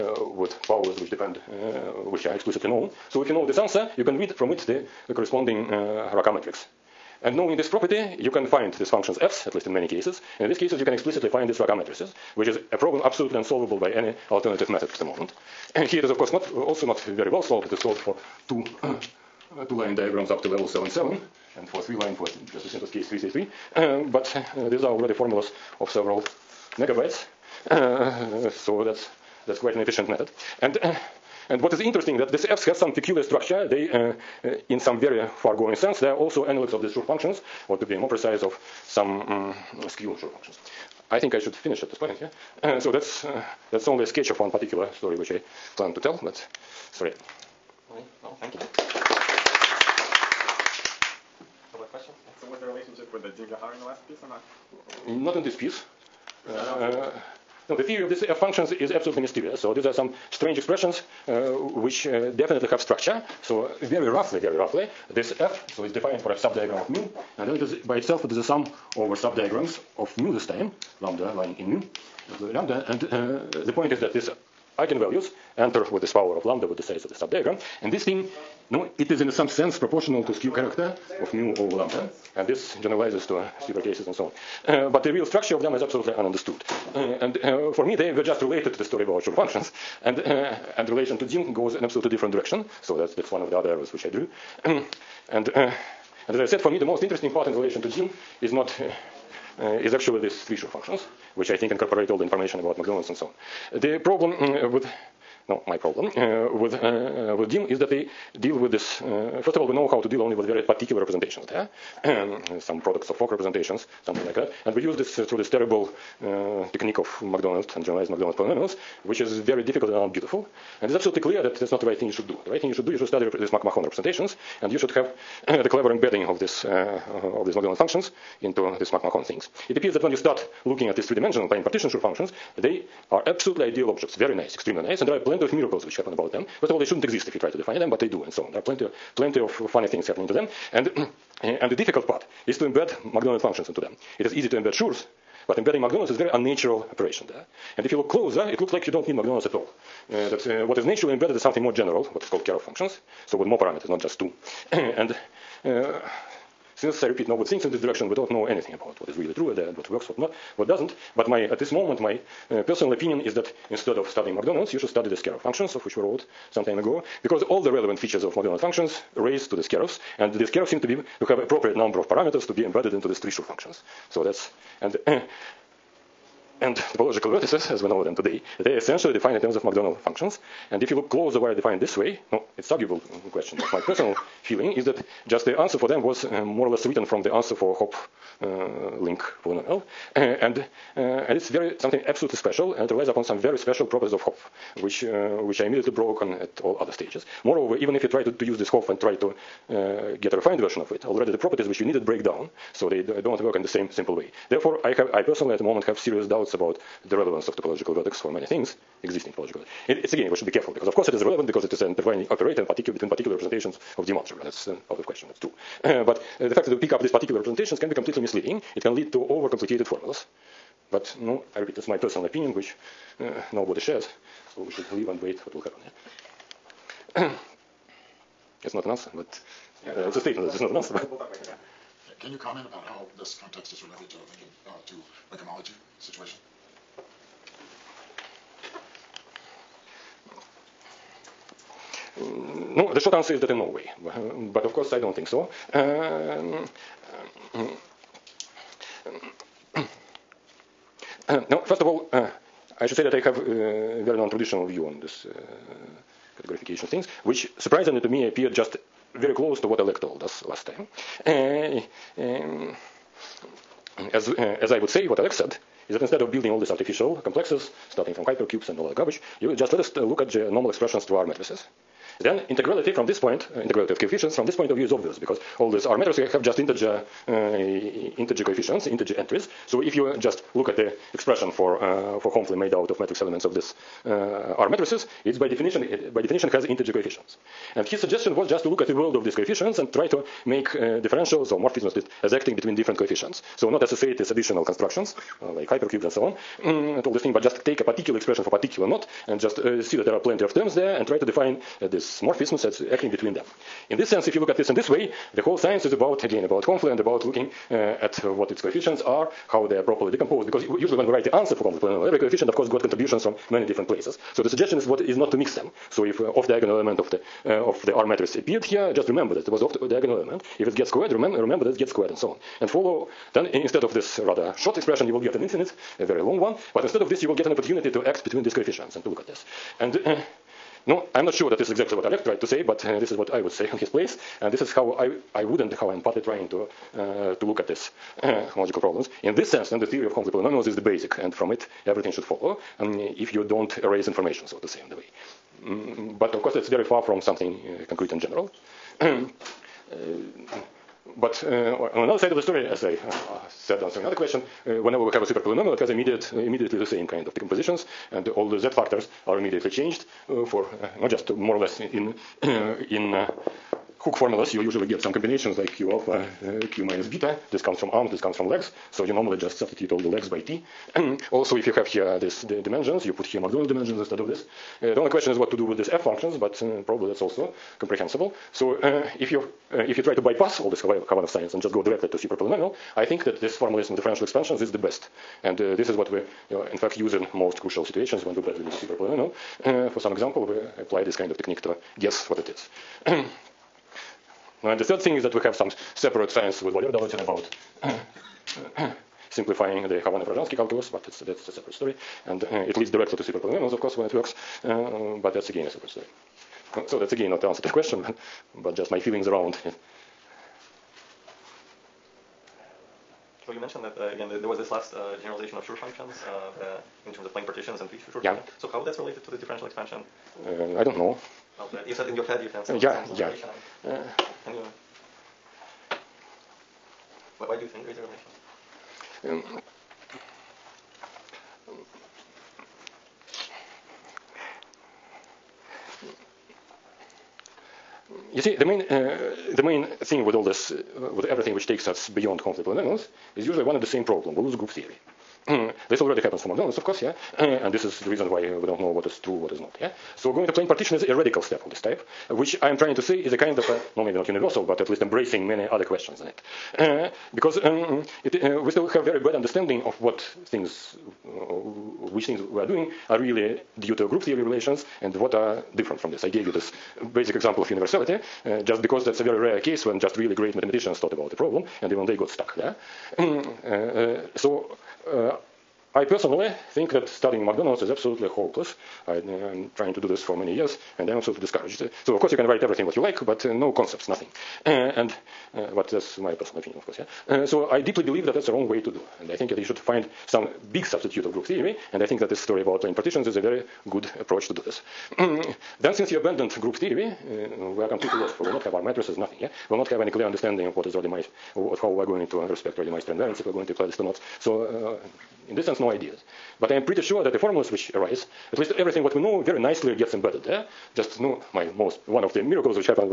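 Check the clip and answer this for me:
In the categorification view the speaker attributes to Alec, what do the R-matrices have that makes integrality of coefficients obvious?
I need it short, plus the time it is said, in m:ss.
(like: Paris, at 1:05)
integer entries, at 4:38.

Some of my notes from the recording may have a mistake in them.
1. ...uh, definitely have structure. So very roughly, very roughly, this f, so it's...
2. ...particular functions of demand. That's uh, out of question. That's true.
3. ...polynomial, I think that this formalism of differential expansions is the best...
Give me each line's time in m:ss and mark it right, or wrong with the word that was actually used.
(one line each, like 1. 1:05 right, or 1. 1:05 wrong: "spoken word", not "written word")
1. 1:02 right
2. 3:33 wrong: "representations", not "functions"
3. 6:22 right.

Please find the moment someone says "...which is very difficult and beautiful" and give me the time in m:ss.
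1:59.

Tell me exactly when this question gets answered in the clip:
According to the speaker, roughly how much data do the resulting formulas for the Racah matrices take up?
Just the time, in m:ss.
0:25.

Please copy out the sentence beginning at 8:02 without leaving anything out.
So, of course, you can write everything what you like, but uh, no concepts, nothing.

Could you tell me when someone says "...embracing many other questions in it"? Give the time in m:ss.
7:35.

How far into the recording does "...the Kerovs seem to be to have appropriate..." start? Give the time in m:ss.
2:50.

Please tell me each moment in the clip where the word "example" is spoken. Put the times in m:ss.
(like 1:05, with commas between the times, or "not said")
6:30, 7:47.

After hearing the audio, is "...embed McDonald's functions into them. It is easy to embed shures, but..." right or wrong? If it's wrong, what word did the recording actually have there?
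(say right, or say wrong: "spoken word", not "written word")
right.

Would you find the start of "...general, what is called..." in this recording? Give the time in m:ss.
2:31.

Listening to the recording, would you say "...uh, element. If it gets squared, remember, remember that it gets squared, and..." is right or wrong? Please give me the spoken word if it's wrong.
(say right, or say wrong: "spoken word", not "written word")
right.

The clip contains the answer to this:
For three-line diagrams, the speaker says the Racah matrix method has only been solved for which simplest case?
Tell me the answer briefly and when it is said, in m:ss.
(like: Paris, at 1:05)
333, at 0:23.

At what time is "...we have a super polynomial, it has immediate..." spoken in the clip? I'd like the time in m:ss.
5:55.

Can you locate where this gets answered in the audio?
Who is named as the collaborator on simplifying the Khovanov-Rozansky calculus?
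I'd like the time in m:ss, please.
6:36.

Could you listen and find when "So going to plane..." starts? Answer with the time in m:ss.
7:30.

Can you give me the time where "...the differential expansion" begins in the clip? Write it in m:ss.
6:59.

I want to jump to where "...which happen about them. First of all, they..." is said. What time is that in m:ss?
2:15.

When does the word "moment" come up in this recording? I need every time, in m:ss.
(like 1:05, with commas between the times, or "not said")
0:15, 2:41, 3:25.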